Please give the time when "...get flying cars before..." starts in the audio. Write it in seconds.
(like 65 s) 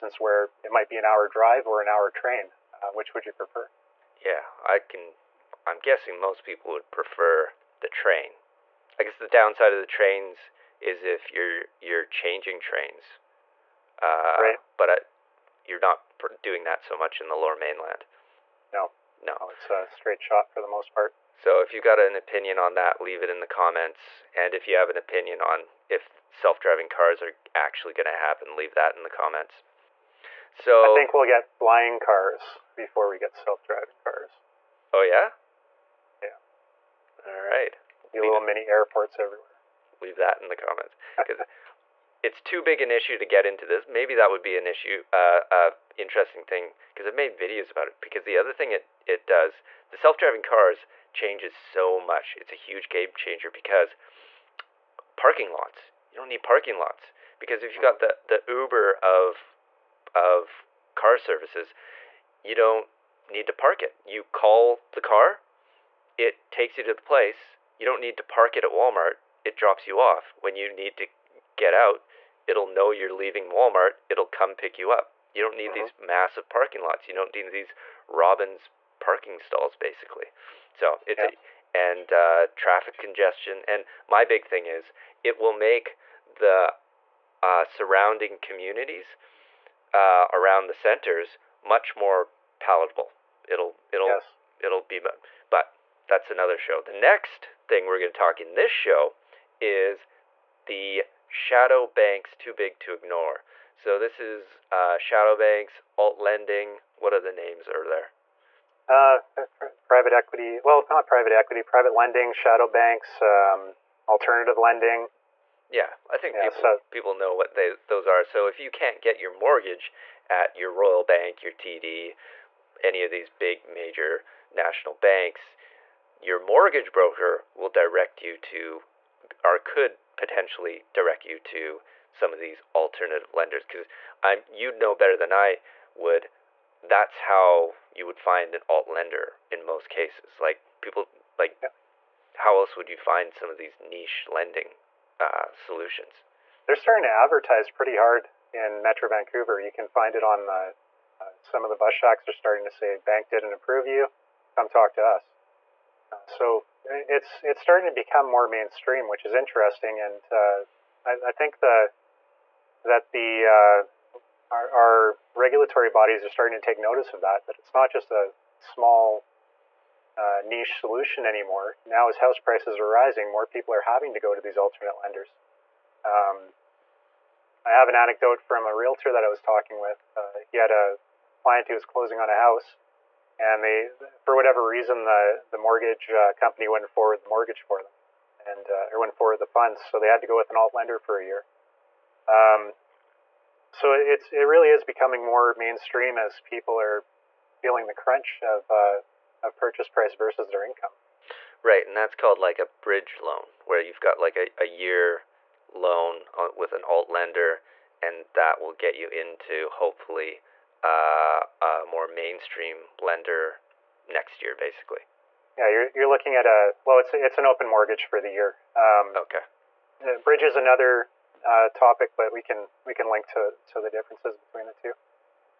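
31 s.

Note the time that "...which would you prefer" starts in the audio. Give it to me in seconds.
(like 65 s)
2 s.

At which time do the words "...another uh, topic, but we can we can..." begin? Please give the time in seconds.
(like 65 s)
220 s.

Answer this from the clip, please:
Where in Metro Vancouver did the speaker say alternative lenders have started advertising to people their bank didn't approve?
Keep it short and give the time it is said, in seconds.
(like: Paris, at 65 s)
bus shacks, at 151 s.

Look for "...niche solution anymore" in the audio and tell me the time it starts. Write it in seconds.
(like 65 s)
170 s.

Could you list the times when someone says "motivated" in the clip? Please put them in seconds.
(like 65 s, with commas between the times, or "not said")
not said.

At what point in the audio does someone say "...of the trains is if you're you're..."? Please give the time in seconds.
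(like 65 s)
9 s.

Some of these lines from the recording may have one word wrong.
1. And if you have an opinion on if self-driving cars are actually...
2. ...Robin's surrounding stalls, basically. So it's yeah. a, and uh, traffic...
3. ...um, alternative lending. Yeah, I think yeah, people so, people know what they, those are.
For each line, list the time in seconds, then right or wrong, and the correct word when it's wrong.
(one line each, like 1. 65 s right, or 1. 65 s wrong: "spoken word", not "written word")
1. 24 s right
2. 78 s wrong: "parking", not "surrounding"
3. 113 s right.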